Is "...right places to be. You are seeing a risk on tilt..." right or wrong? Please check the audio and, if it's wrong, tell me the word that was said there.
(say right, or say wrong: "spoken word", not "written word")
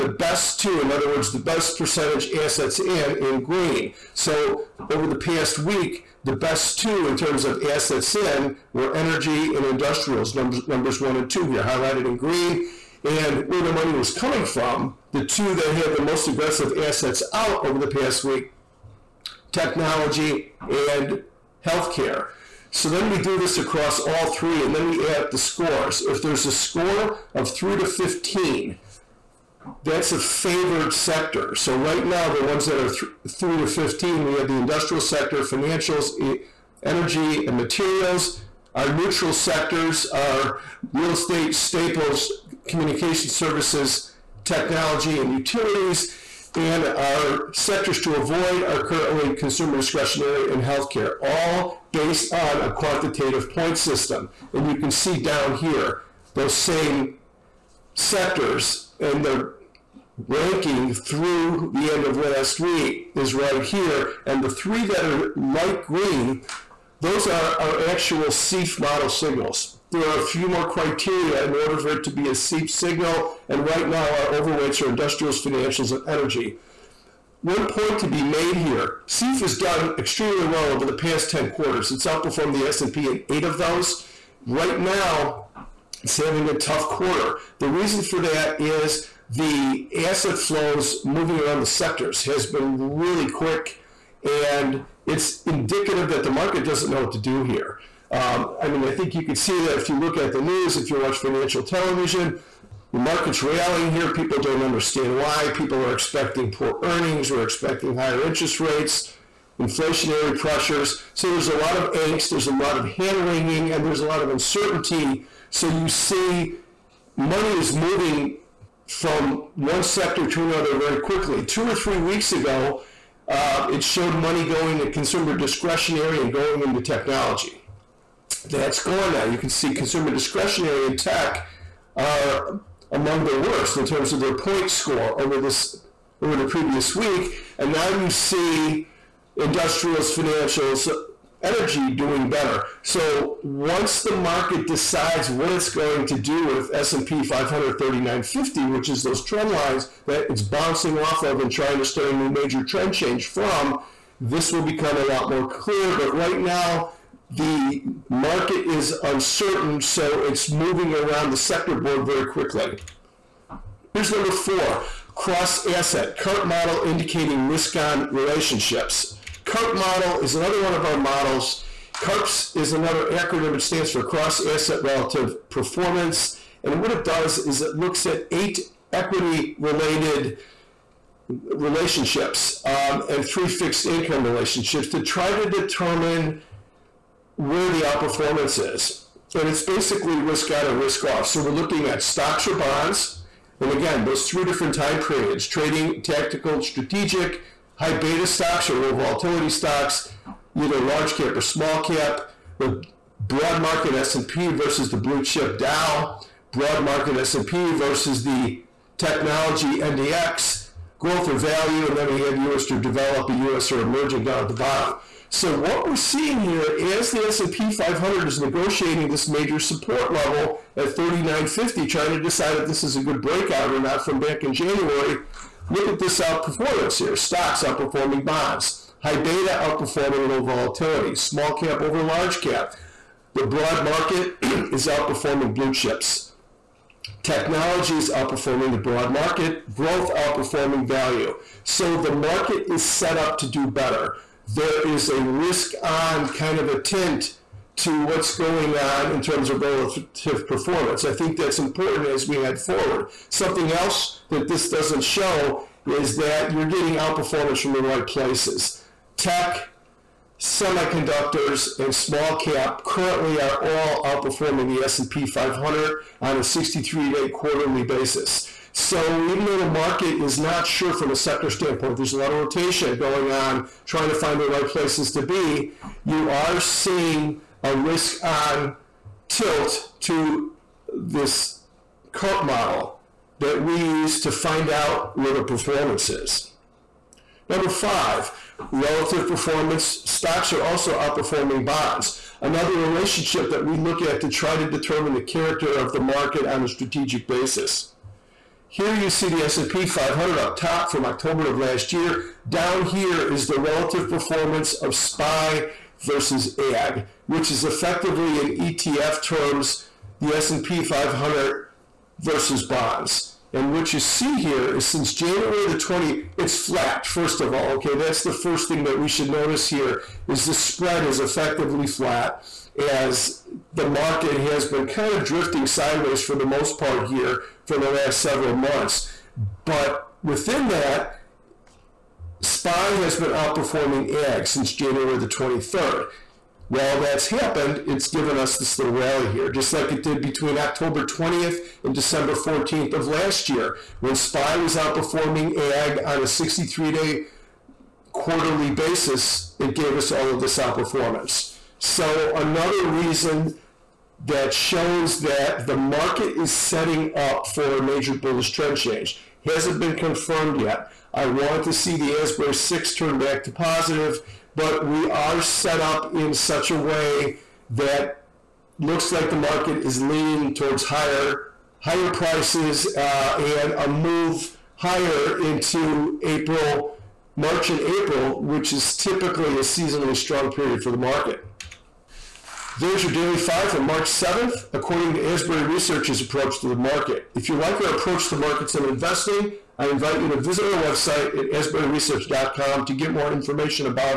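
right.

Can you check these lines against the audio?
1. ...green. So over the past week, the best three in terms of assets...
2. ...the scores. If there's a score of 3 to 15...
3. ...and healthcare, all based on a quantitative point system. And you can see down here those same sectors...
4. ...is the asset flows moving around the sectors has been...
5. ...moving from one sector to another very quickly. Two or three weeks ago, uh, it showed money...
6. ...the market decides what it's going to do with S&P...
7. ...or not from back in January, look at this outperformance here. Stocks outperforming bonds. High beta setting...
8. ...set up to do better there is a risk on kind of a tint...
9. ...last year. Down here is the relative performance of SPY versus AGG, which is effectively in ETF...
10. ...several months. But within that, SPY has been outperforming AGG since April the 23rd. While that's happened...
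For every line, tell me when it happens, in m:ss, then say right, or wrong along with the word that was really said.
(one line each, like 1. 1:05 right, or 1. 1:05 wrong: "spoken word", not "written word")
1. 0:03 wrong: "two", not "three"
2. 0:25 right
3. 0:50 right
4. 1:28 right
5. 1:57 right
6. 2:24 right
7. 3:43 wrong: "outperforming", not "setting"
8. 4:02 right
9. 5:01 right
10. 5:28 wrong: "January", not "April".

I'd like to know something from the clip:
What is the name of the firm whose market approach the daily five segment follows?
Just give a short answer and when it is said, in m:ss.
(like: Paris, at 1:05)
Asbury Research, at 6:25.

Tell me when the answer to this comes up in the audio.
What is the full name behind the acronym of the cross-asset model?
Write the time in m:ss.
2:54.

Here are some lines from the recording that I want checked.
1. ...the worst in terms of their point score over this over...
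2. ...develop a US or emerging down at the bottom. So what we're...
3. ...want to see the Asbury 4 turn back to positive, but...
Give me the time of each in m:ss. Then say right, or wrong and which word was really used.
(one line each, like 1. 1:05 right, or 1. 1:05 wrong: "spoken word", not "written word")
1. 2:13 right
2. 3:32 right
3. 6:01 wrong: "6", not "4".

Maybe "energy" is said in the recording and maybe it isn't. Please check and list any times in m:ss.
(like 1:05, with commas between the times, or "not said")
0:08, 0:36, 1:16, 2:21.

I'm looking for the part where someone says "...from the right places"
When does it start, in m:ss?
4:17.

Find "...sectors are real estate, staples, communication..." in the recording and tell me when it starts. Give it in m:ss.
0:39.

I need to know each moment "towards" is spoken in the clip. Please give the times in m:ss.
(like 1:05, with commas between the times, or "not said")
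6:10.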